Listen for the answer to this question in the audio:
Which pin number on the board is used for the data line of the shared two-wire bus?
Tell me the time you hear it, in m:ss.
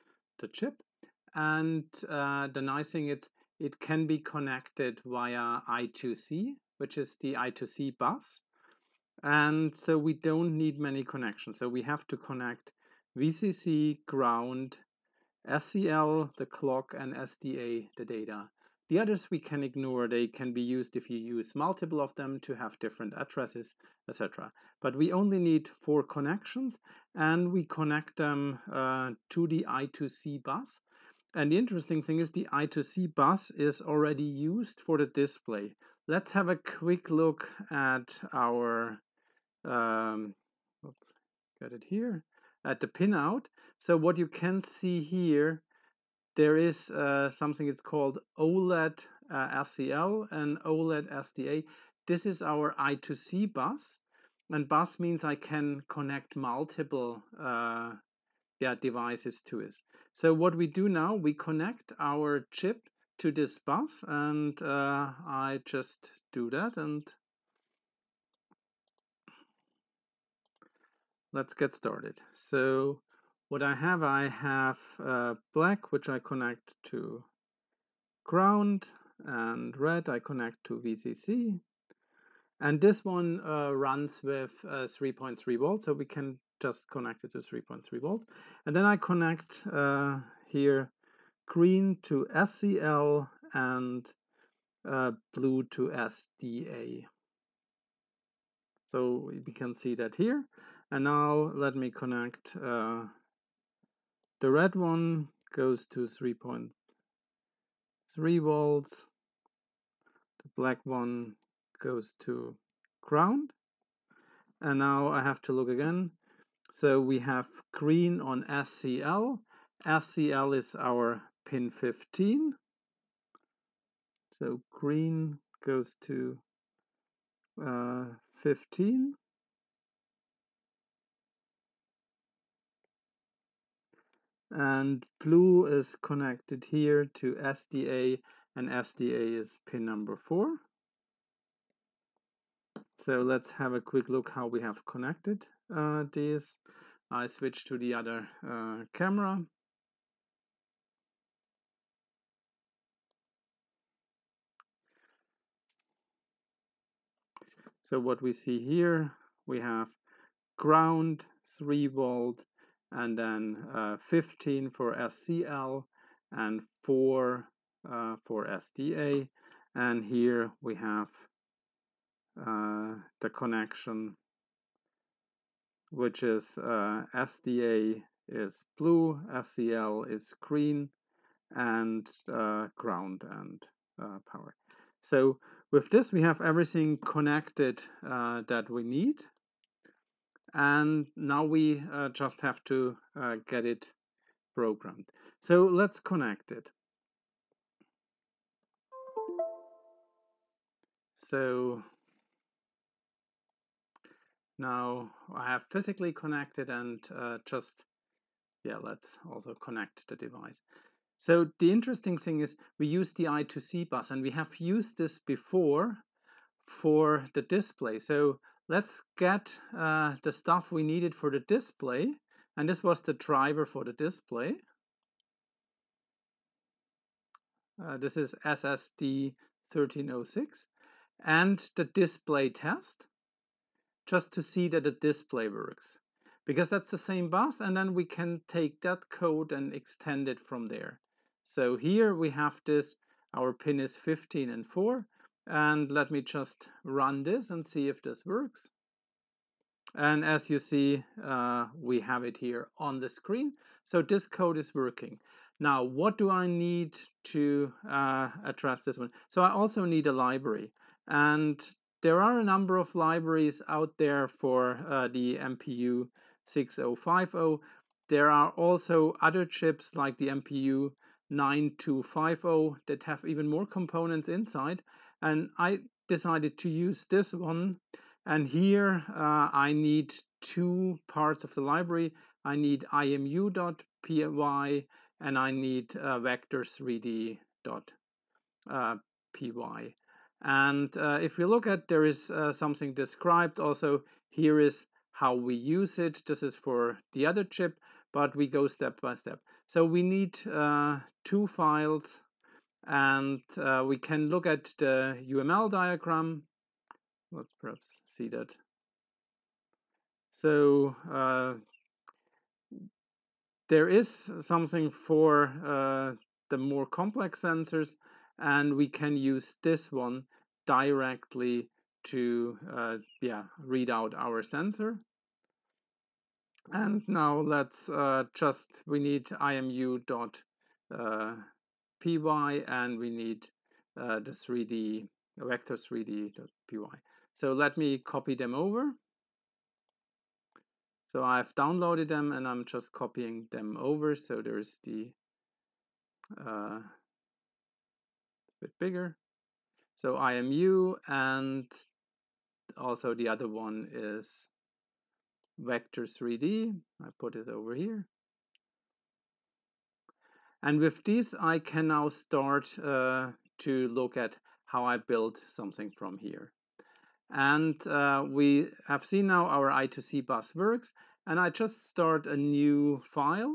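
2:18.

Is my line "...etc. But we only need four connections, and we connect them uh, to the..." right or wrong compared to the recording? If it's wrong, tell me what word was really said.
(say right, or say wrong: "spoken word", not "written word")
right.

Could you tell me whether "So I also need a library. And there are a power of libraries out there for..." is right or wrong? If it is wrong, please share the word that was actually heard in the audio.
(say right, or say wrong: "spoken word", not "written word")
wrong: "number", not "power".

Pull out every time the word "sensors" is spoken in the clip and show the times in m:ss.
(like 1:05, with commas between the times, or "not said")
5:17, 5:24.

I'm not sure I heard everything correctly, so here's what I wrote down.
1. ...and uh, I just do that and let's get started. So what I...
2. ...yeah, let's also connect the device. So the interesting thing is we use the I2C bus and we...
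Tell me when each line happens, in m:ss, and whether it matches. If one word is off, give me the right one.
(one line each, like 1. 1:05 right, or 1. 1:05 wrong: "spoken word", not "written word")
1. 1:04 right
2. 3:28 right.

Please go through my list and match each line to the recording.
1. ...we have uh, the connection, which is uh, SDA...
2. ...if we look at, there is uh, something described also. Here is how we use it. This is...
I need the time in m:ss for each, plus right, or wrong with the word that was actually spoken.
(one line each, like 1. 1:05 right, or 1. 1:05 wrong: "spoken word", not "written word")
1. 2:50 right
2. 4:51 right.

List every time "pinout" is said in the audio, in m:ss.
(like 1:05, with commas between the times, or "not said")
0:42.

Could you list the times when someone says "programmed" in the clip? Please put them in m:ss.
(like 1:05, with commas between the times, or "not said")
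3:14.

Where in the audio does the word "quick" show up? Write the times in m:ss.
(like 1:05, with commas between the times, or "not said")
0:36, 2:23.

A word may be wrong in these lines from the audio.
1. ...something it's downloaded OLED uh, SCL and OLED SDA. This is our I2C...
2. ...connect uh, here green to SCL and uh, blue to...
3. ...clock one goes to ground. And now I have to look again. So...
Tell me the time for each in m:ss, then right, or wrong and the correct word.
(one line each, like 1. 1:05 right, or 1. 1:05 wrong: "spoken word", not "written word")
1. 0:47 wrong: "called", not "downloaded"
2. 1:28 right
3. 1:50 wrong: "black", not "clock".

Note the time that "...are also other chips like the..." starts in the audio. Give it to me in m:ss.
4:28.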